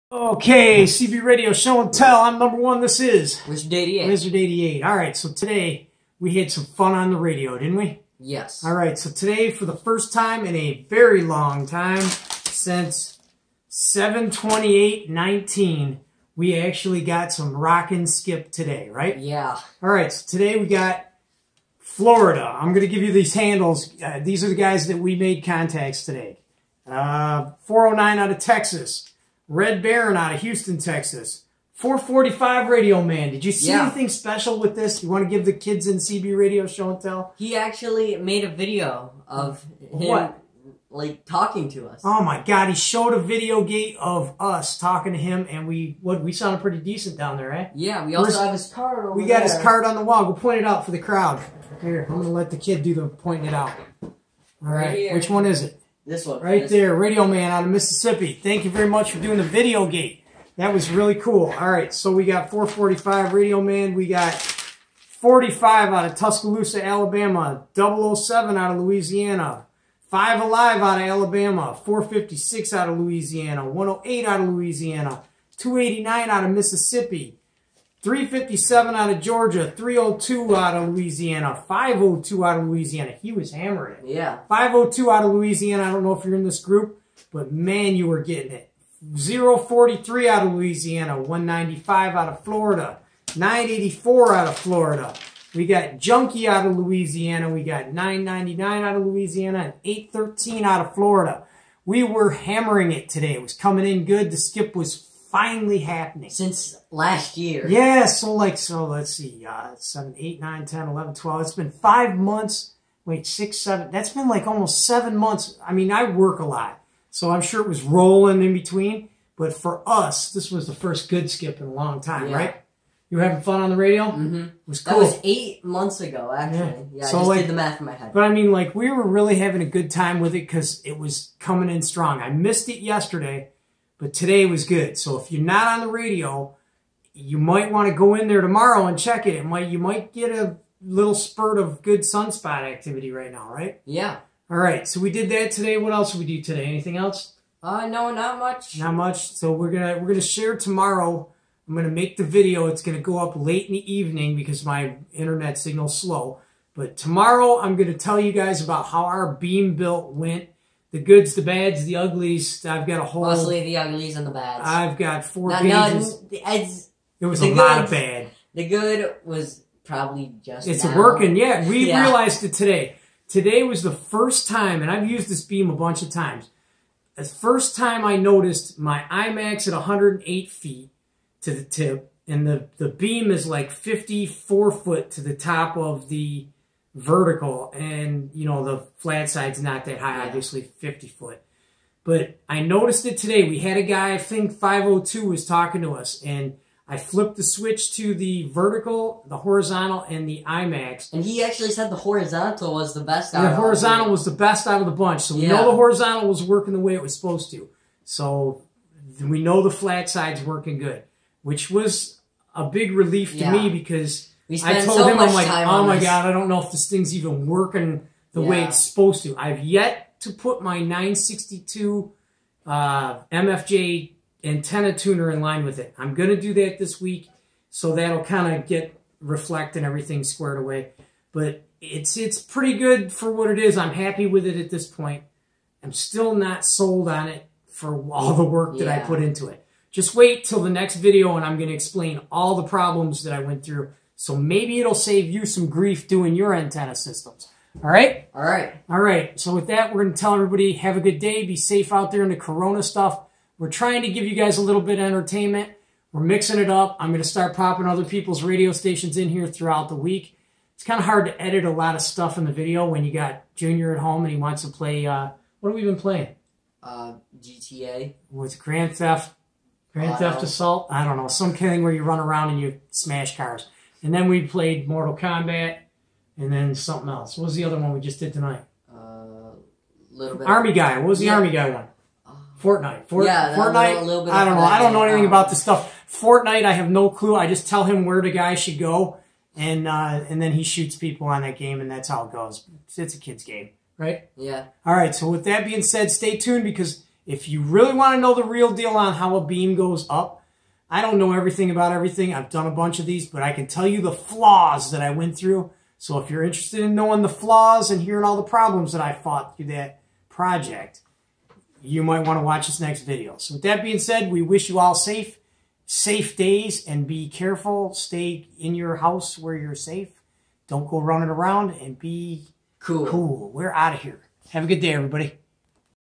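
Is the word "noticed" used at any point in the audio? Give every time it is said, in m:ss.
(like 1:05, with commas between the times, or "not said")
2:58, 3:12.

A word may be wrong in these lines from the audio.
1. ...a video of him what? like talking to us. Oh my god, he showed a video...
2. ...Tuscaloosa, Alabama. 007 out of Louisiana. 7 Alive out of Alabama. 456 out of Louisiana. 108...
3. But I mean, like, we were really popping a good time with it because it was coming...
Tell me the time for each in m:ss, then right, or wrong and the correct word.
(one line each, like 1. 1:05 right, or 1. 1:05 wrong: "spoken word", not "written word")
1. 0:38 right
2. 1:06 wrong: "5", not "7"
3. 2:08 wrong: "having", not "popping".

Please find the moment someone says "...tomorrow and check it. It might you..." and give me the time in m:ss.
2:18.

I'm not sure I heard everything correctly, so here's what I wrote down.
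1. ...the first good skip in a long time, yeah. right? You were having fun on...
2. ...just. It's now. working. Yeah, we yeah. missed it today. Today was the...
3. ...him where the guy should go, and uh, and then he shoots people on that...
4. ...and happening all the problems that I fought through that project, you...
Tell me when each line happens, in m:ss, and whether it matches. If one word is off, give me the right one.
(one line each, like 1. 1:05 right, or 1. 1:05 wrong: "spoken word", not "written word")
1. 2:00 right
2. 2:50 wrong: "realized", not "missed"
3. 4:47 right
4. 5:07 wrong: "hearing", not "happening".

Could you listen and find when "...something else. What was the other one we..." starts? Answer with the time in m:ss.
4:36.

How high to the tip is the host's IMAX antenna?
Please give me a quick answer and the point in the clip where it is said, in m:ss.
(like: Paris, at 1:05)
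108 feet, at 2:59.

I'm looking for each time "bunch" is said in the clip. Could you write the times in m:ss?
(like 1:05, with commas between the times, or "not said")
2:55, 3:24, 5:02.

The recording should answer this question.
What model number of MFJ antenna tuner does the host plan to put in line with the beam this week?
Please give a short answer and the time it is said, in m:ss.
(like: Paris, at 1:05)
962, at 3:40.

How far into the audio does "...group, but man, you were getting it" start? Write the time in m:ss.
1:26.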